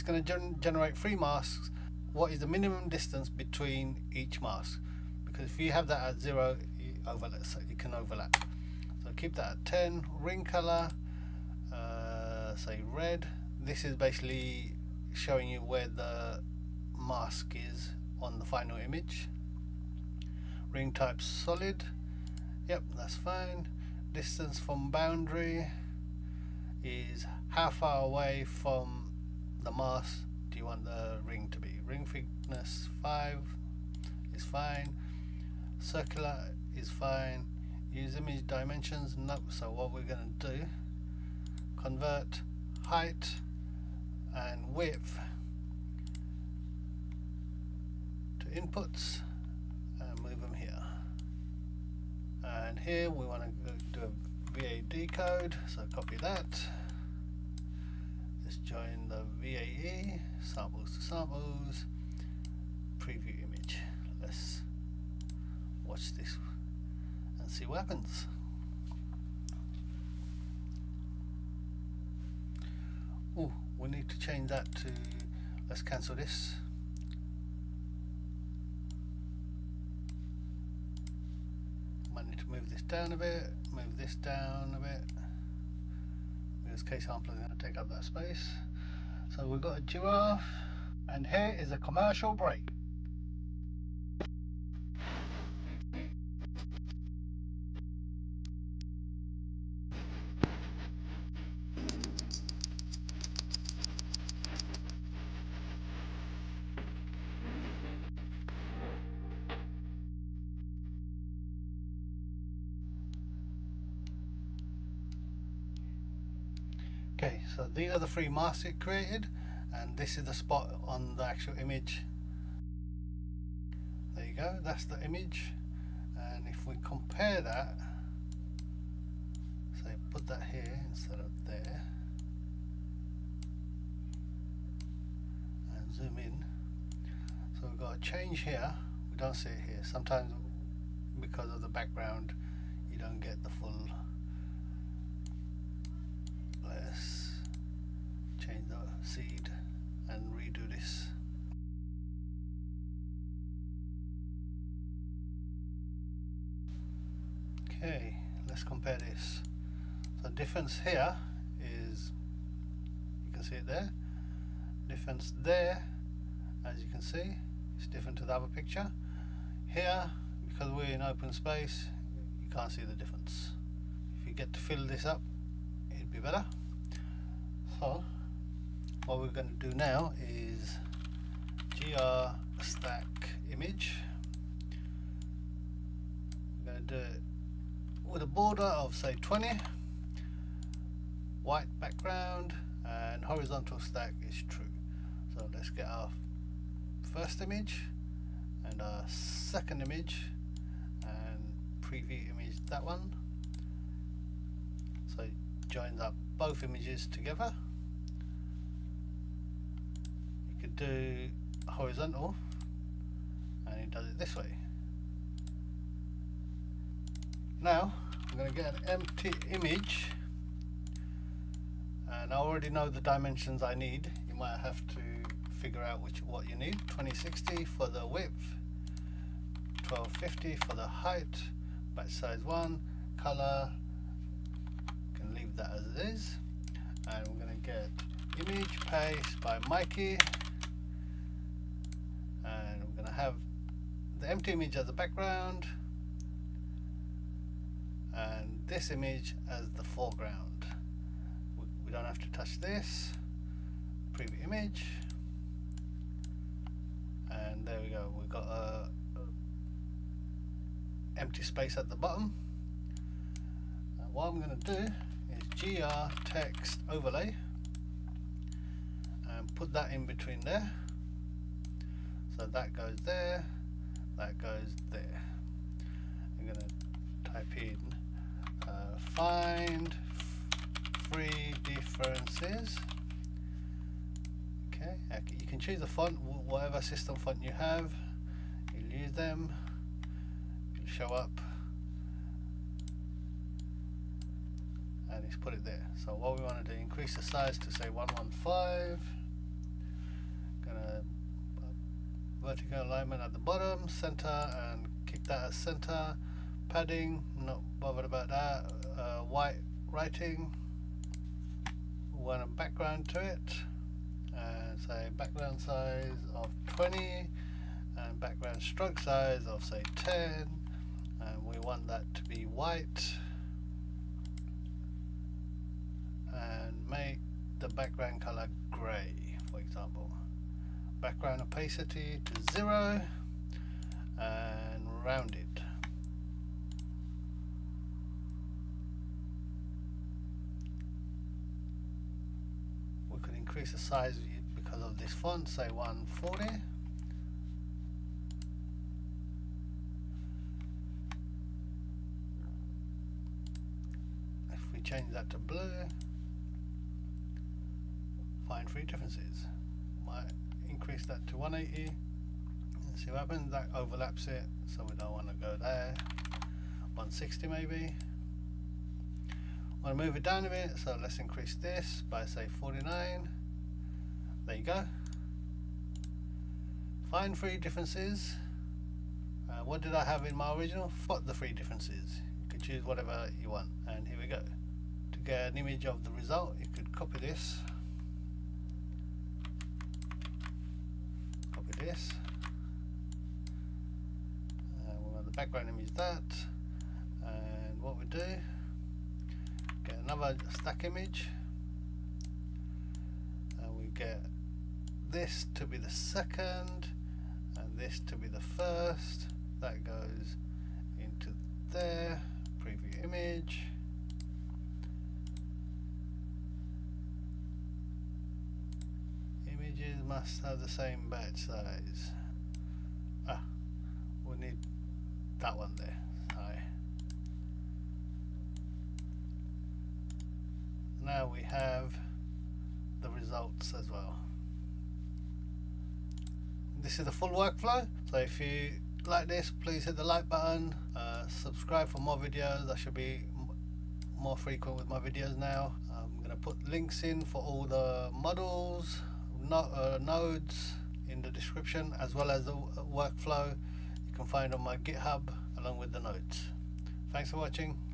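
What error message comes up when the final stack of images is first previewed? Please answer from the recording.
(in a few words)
Images must have the same batch size.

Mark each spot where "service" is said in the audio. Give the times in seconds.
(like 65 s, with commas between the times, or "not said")
not said.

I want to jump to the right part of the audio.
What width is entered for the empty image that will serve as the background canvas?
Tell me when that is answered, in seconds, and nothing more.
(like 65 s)
226 s.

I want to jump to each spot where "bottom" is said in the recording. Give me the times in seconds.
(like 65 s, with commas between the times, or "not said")
261 s, 303 s.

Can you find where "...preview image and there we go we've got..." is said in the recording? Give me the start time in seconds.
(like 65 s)
254 s.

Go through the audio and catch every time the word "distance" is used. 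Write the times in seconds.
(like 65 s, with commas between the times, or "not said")
2 s, 24 s.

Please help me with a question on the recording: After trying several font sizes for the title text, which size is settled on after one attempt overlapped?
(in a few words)
160.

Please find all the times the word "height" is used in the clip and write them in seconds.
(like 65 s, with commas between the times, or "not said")
42 s, 230 s.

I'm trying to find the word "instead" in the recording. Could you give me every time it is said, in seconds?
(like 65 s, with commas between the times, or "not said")
130 s.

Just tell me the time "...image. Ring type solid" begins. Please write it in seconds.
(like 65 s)
18 s.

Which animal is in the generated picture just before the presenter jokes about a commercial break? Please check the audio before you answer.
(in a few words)
Giraffe.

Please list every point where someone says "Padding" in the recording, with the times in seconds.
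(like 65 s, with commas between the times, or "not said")
306 s.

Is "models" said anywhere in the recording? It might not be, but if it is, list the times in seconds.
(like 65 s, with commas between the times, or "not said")
448 s.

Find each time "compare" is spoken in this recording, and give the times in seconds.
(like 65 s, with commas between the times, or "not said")
126 s, 158 s.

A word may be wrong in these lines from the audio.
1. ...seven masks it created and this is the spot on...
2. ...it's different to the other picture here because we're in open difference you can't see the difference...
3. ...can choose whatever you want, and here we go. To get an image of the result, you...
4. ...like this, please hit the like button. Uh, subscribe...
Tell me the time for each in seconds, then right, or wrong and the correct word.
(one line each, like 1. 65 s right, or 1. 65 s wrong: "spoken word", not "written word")
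1. 118 s wrong: "three", not "seven"
2. 167 s wrong: "space", not "difference"
3. 382 s right
4. 439 s right.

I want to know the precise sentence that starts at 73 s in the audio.
Oh, we need to change that to, let's cancel this.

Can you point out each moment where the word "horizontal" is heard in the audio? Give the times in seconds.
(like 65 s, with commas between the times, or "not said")
193 s, 211 s.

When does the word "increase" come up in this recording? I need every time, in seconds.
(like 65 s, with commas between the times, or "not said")
296 s, 343 s, 360 s, 371 s.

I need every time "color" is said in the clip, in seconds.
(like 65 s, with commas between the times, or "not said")
10 s, 233 s, 328 s.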